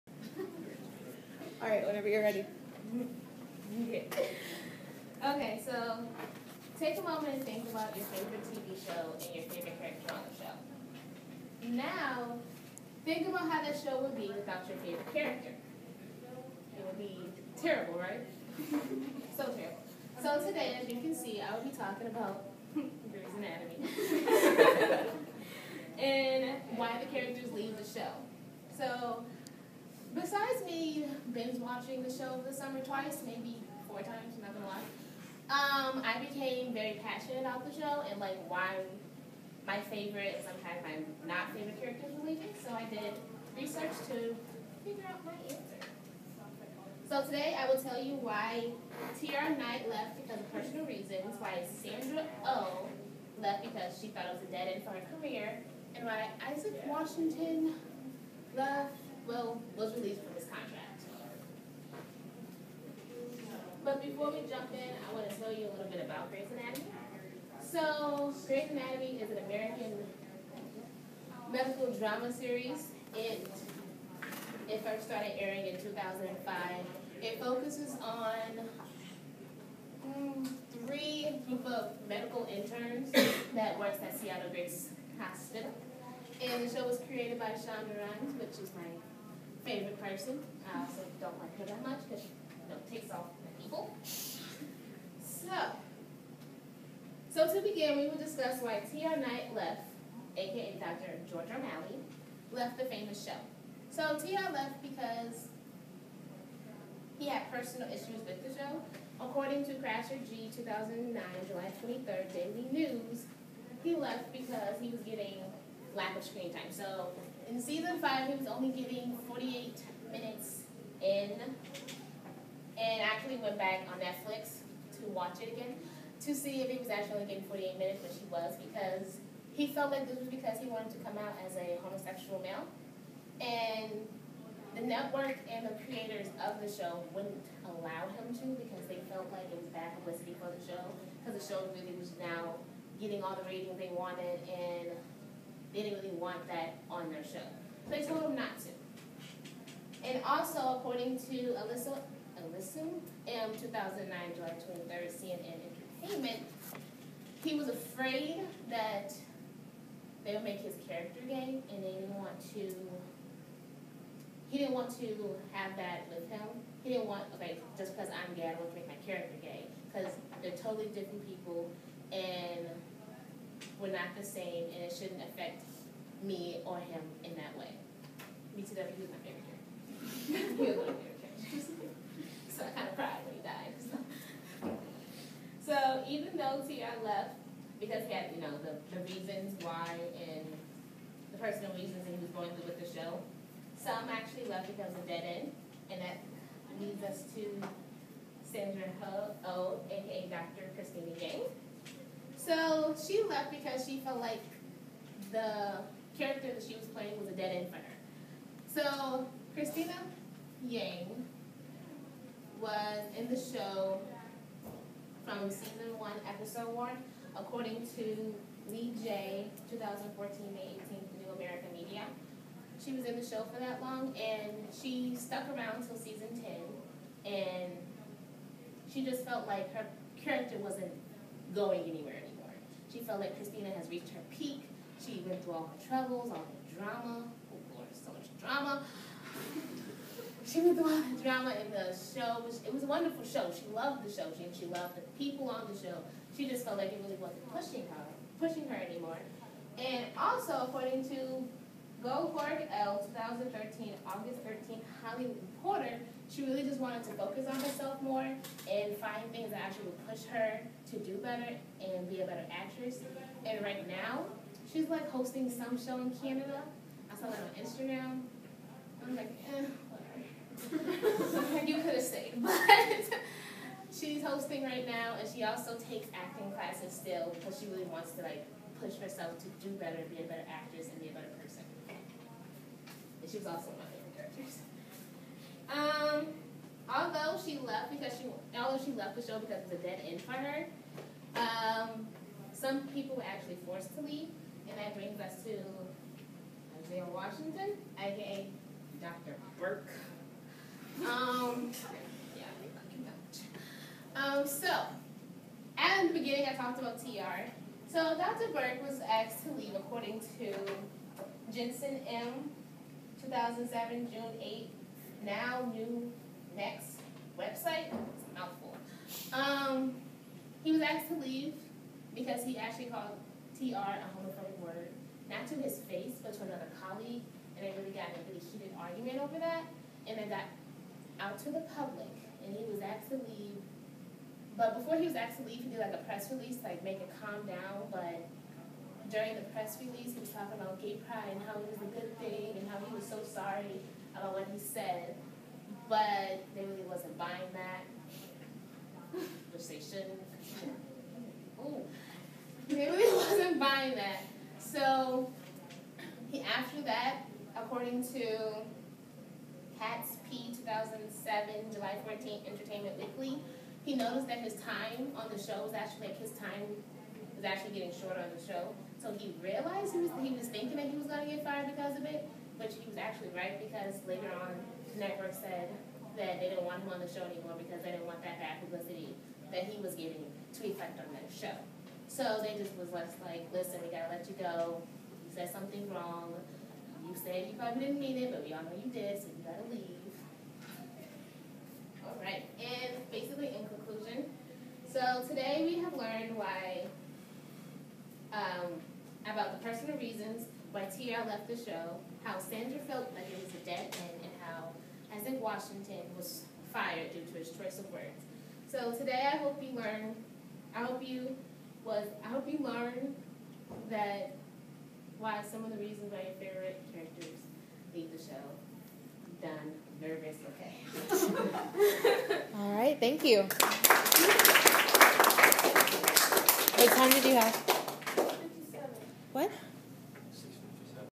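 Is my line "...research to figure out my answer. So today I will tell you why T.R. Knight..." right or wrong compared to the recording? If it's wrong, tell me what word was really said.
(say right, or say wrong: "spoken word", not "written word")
right.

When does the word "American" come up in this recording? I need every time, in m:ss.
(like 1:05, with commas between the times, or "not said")
1:09, 3:41.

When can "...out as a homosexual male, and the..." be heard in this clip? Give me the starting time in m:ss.
2:11.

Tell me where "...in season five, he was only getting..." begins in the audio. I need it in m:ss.
1:57.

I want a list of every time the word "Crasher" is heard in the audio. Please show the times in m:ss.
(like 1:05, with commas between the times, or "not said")
1:49.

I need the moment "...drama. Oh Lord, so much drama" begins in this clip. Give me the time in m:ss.
3:56.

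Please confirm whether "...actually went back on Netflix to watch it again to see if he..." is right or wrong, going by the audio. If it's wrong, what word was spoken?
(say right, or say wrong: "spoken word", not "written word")
right.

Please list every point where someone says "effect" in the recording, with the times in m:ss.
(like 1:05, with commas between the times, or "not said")
6:20.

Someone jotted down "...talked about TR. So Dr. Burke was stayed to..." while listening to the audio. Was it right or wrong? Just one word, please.
wrong.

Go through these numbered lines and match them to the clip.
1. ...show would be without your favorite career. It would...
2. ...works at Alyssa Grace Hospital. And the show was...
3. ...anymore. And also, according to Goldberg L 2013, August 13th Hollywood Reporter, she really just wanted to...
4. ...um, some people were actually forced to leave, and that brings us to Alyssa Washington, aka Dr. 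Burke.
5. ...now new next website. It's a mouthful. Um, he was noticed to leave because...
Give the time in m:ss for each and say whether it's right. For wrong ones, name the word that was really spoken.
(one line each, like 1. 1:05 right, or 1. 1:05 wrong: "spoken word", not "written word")
1. 0:13 wrong: "character", not "career"
2. 1:23 wrong: "Seattle", not "Alyssa"
3. 4:08 right
4. 4:51 wrong: "Isaiah", not "Alyssa"
5. 5:15 wrong: "asked", not "noticed".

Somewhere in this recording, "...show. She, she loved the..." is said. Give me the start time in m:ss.
4:04.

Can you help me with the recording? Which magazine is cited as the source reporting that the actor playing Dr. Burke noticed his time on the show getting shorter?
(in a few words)
Entertainment Weekly.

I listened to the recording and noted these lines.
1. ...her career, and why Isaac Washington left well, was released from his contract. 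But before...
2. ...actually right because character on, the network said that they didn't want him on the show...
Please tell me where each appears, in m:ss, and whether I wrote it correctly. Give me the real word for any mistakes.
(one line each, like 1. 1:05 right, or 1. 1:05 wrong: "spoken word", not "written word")
1. 0:54 right
2. 6:13 wrong: "later", not "character".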